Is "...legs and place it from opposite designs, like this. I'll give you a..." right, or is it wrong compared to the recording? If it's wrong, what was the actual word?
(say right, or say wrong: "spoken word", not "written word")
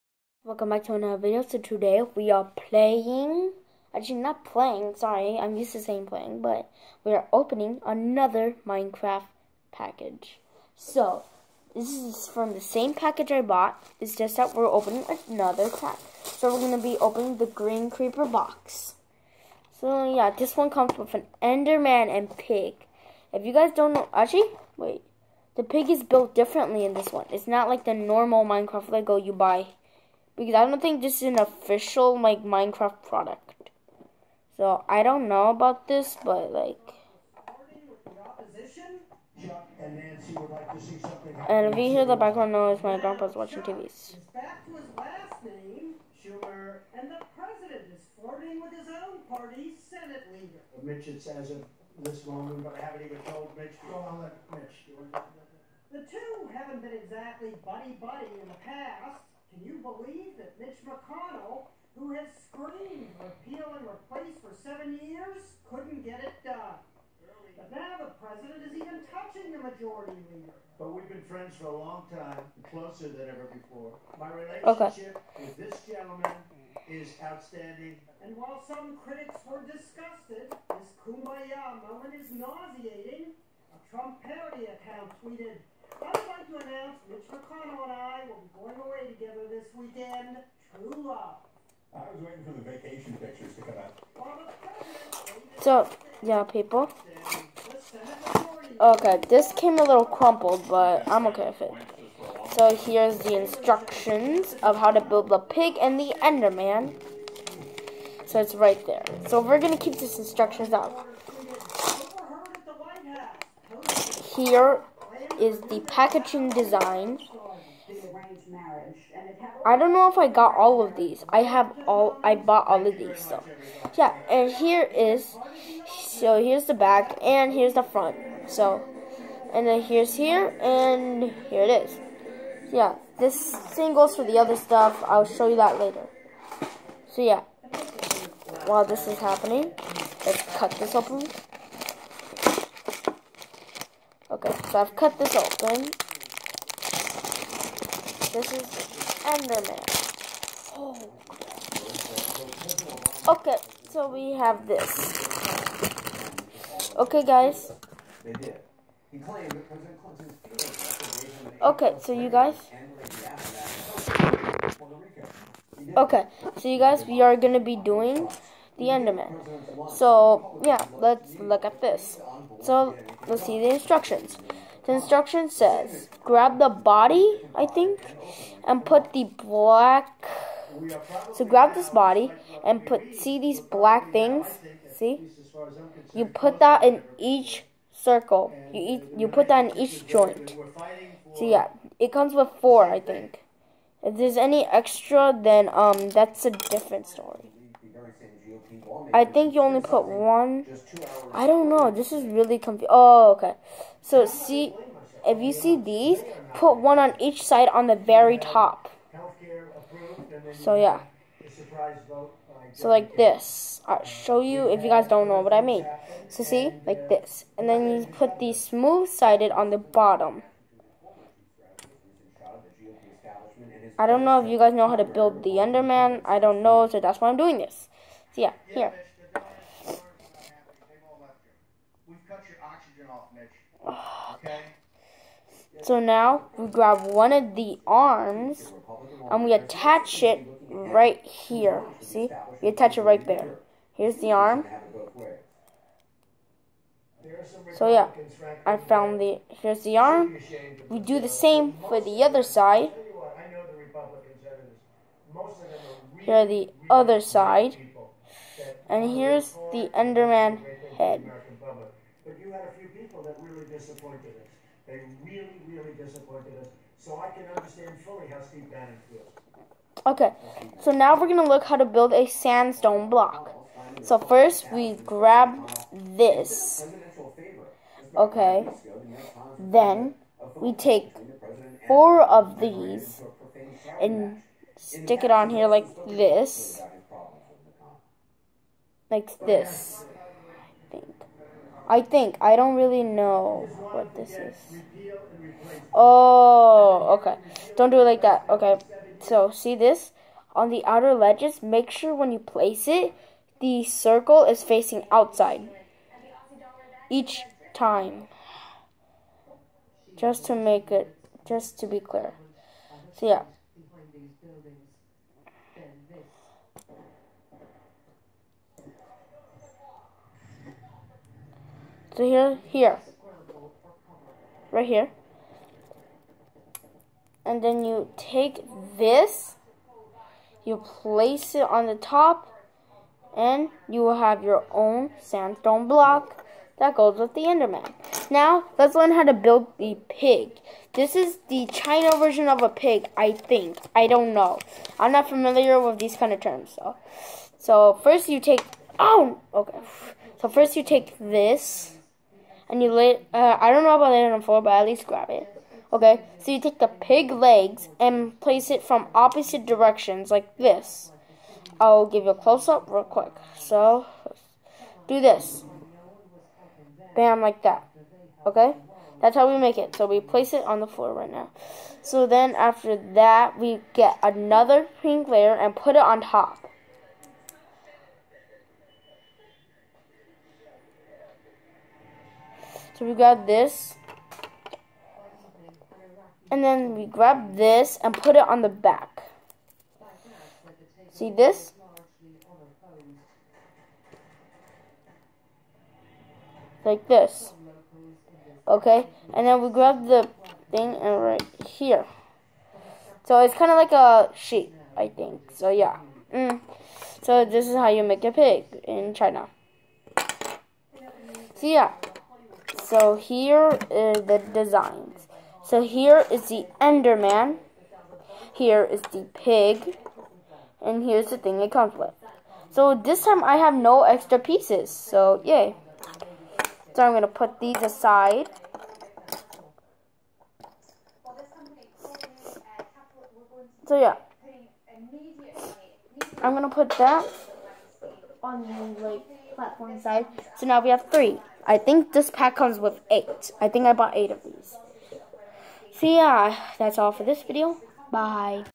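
wrong: "directions", not "designs".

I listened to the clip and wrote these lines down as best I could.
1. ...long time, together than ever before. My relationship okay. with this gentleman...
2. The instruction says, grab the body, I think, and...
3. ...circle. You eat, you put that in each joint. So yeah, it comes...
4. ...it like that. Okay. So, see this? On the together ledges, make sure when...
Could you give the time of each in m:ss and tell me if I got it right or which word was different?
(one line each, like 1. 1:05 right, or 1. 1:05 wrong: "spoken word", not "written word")
1. 1:11 wrong: "closer", not "together"
2. 2:54 right
3. 3:07 right
4. 4:57 wrong: "outer", not "together".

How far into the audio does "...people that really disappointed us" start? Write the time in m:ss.
4:22.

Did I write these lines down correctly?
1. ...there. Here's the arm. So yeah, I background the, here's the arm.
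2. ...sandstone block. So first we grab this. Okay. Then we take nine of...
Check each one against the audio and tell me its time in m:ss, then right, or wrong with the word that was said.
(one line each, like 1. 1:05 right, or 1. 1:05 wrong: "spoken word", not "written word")
1. 4:03 wrong: "found", not "background"
2. 4:32 wrong: "four", not "nine".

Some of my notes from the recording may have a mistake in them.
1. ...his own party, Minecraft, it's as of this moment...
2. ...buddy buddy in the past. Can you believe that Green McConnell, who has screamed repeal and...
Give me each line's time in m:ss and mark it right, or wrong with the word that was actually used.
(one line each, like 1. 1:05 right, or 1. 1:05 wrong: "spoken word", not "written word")
1. 0:48 wrong: "Mitch", not "Minecraft"
2. 0:57 wrong: "Mitch", not "Green".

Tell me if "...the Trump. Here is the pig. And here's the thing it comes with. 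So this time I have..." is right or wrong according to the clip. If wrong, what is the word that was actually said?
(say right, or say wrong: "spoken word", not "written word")
wrong: "Enderman", not "Trump".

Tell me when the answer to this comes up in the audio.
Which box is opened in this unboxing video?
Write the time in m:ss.
0:17.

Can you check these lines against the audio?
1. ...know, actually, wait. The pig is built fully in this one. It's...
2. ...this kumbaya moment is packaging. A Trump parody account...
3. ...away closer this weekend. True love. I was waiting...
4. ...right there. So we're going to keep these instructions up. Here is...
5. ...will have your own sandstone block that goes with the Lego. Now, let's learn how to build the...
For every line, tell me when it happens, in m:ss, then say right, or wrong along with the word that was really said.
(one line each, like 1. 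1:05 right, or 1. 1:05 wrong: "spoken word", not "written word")
1. 0:23 wrong: "differently", not "fully"
2. 1:20 wrong: "nauseating", not "packaging"
3. 1:28 wrong: "together", not "closer"
4. 1:48 right
5. 5:34 wrong: "Enderman", not "Lego".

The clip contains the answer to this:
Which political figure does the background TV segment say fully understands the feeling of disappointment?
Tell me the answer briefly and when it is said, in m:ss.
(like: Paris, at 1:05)
Steve Bannon, at 4:28.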